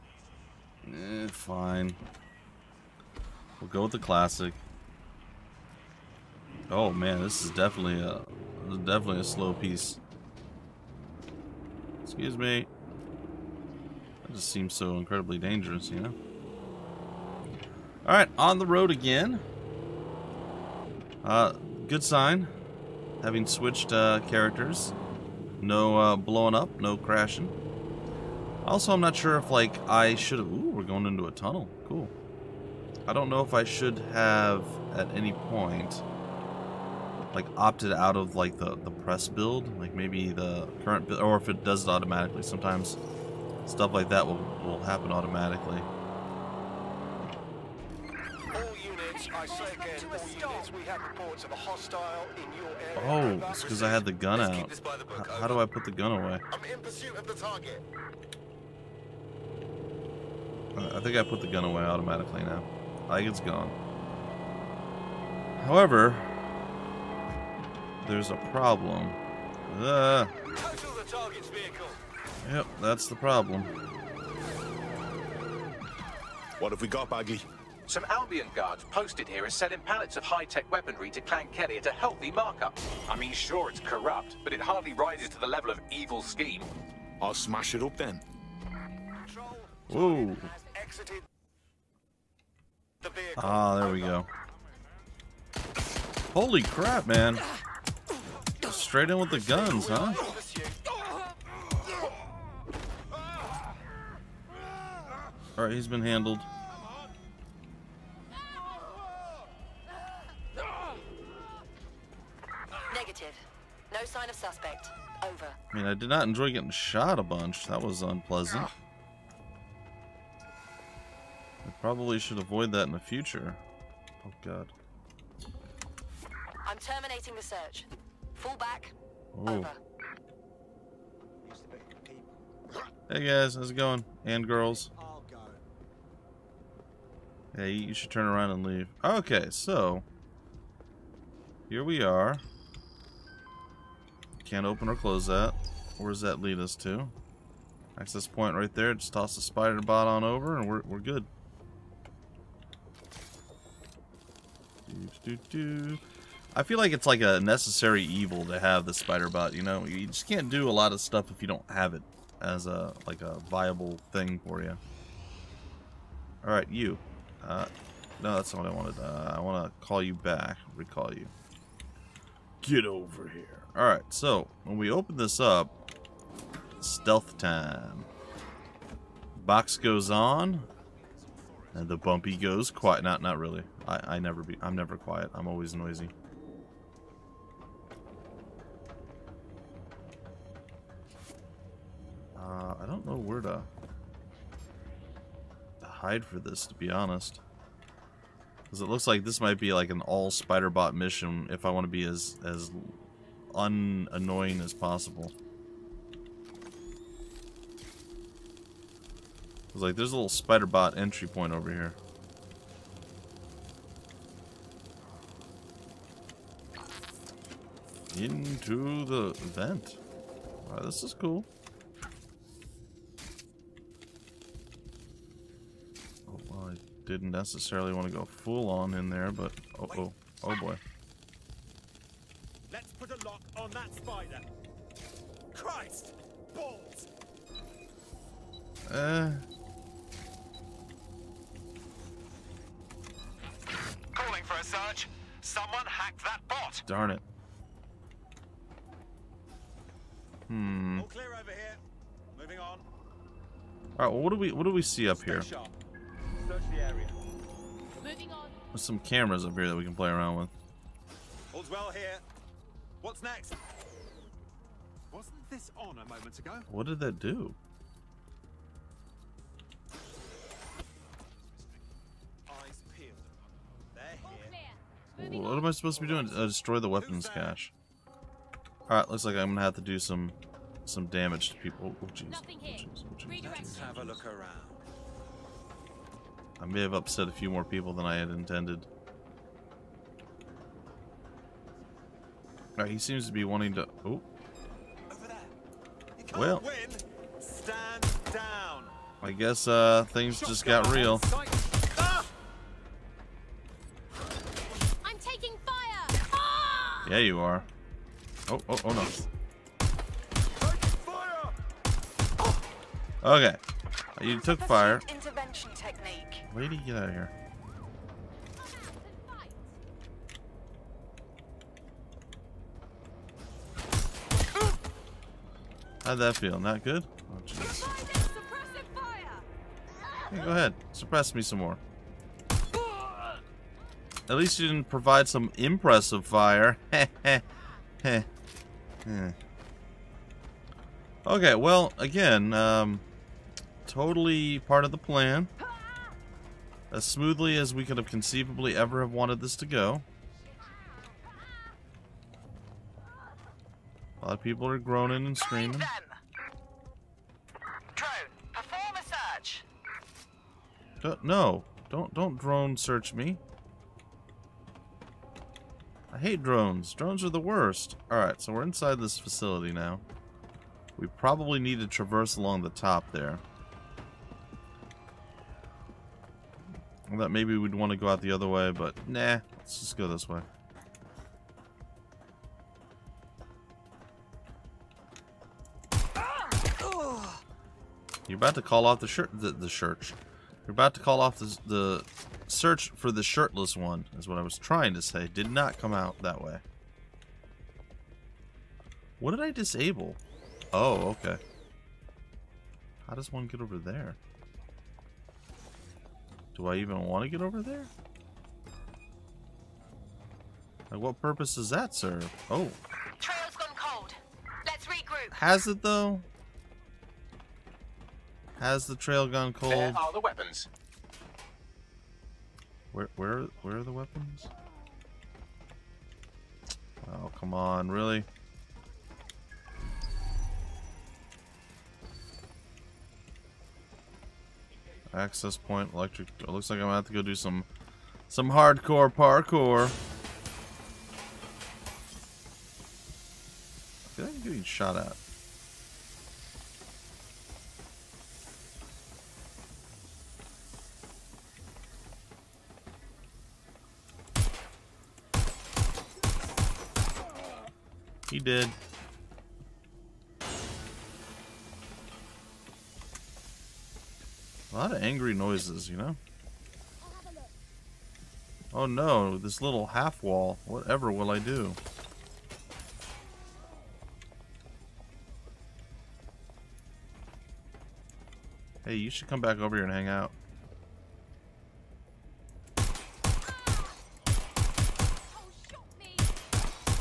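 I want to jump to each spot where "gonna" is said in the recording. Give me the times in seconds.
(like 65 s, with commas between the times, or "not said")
279 s, 436 s.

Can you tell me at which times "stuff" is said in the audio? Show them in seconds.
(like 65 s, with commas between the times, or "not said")
43 s, 160 s.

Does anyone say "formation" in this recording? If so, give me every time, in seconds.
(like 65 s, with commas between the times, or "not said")
not said.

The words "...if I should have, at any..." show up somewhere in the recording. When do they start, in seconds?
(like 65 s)
33 s.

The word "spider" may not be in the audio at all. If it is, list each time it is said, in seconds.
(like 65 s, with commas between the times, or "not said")
149 s, 158 s, 200 s, 210 s, 233 s.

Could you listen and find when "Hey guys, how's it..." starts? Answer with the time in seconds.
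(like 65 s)
133 s.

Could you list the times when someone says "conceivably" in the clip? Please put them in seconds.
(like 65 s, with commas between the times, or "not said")
348 s.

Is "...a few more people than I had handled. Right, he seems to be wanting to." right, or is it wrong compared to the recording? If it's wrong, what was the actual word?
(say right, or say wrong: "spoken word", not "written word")
wrong: "intended", not "handled".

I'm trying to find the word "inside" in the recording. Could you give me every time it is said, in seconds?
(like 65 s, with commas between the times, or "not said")
368 s.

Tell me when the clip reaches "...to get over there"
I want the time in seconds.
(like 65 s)
407 s.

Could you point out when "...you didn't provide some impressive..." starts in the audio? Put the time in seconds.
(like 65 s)
334 s.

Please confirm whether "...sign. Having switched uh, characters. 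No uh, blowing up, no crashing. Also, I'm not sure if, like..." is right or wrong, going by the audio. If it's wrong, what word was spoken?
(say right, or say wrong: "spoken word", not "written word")
right.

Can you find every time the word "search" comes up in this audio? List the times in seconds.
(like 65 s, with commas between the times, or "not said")
127 s, 362 s, 392 s.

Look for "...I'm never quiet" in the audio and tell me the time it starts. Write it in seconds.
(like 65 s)
184 s.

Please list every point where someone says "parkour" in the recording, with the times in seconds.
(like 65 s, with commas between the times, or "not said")
439 s.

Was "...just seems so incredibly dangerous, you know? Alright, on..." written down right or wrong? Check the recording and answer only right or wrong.
right.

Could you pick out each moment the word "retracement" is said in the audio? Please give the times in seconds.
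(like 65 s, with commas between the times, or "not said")
not said.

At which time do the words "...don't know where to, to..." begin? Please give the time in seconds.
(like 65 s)
192 s.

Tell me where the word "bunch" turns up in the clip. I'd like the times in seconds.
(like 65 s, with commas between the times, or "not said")
117 s.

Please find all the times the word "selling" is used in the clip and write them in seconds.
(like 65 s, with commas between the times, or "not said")
79 s.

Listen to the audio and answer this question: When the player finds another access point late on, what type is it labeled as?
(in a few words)
electric.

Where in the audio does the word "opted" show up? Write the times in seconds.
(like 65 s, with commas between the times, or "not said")
37 s.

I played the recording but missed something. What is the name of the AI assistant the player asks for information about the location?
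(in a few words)
Bagley.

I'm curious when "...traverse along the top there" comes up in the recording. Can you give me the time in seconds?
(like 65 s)
371 s.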